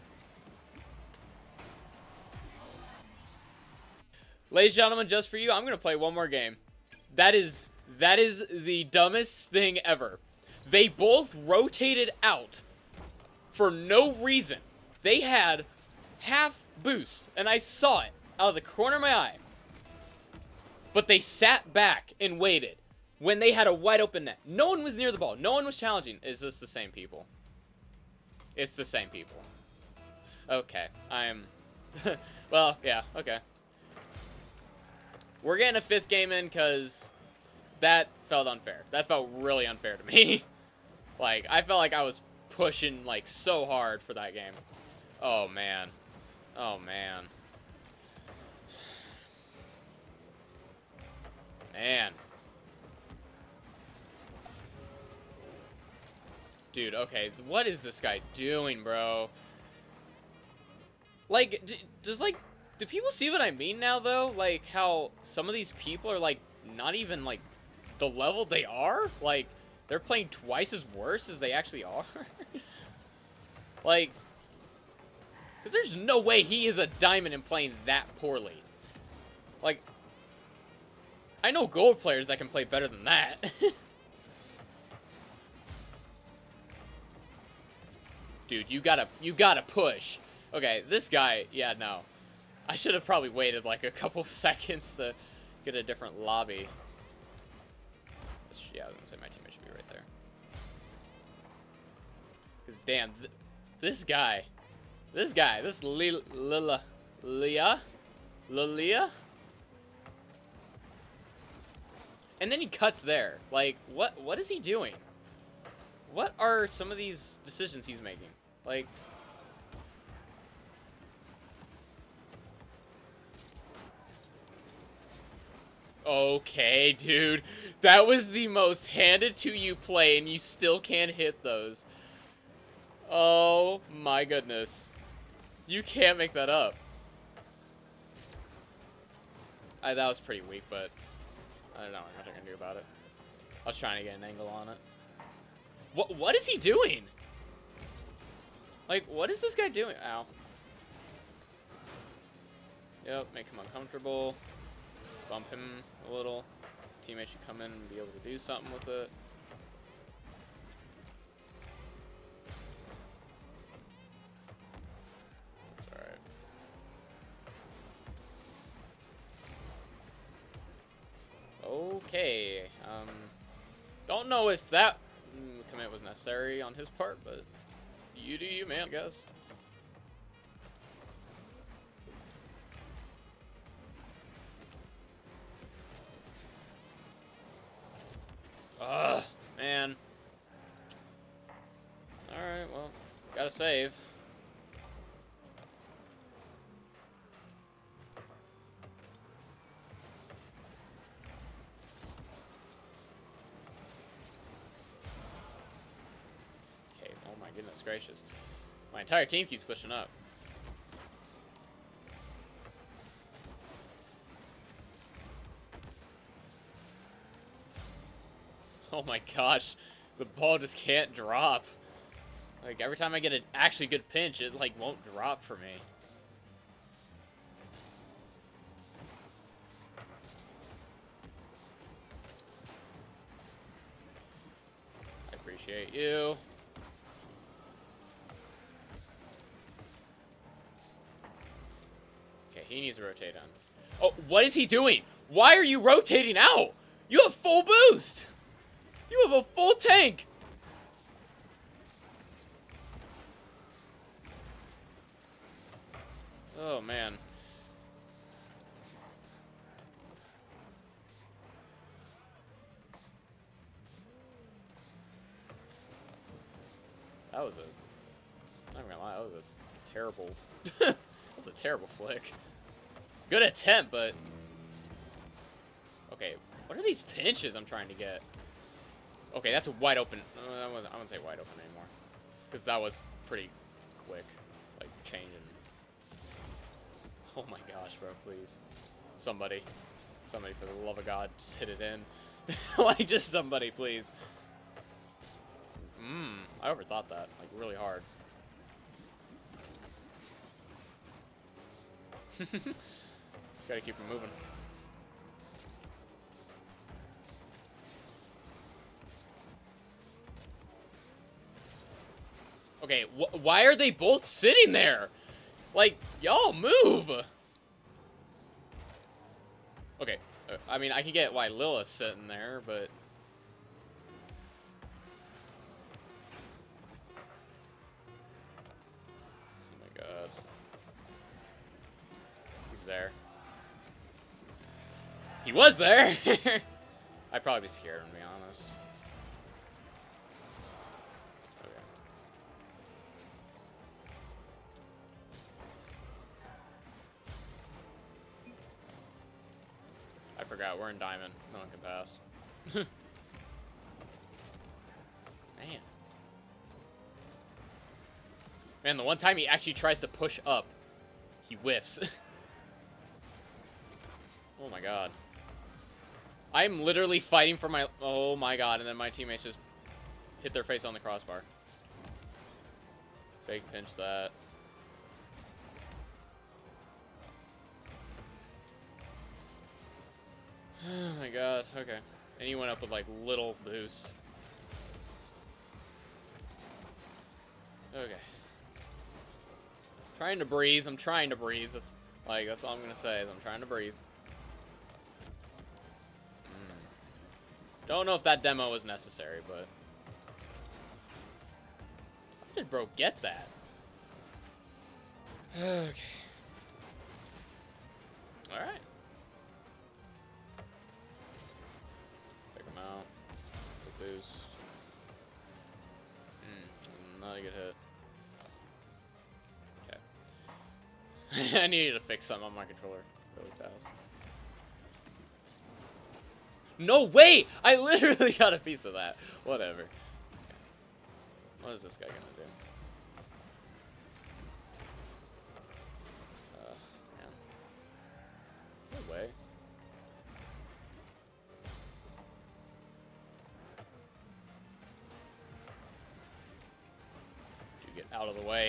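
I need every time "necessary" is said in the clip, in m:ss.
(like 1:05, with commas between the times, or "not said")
2:56, 6:38.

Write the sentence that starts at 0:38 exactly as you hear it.
That felt really unfair to me.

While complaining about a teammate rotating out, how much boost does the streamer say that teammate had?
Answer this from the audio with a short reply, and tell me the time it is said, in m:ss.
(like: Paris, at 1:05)
full boost, at 4:07.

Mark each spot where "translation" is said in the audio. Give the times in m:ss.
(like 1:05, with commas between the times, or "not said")
not said.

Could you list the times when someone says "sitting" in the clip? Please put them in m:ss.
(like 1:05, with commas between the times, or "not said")
5:14, 5:21.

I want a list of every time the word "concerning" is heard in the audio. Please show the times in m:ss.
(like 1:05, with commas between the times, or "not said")
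not said.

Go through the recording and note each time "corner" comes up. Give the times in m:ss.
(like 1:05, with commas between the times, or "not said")
0:18.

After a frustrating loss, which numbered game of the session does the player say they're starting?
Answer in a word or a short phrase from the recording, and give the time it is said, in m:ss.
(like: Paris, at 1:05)
fifth, at 0:35.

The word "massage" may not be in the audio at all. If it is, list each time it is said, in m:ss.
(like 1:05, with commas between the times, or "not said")
not said.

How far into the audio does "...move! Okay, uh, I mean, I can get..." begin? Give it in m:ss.
5:16.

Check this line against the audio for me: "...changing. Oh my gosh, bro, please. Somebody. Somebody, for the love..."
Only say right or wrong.
right.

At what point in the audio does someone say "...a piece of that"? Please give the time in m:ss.
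7:08.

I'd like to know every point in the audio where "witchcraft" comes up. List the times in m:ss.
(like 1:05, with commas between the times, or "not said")
not said.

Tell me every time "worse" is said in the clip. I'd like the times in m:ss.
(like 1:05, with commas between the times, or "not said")
1:10.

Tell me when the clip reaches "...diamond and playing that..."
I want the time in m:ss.
1:16.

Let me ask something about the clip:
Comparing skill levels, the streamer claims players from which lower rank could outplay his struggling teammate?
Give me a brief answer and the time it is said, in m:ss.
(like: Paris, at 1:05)
gold, at 1:21.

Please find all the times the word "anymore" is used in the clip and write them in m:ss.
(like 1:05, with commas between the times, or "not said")
4:41.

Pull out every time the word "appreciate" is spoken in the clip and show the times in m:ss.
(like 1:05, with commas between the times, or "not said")
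3:55.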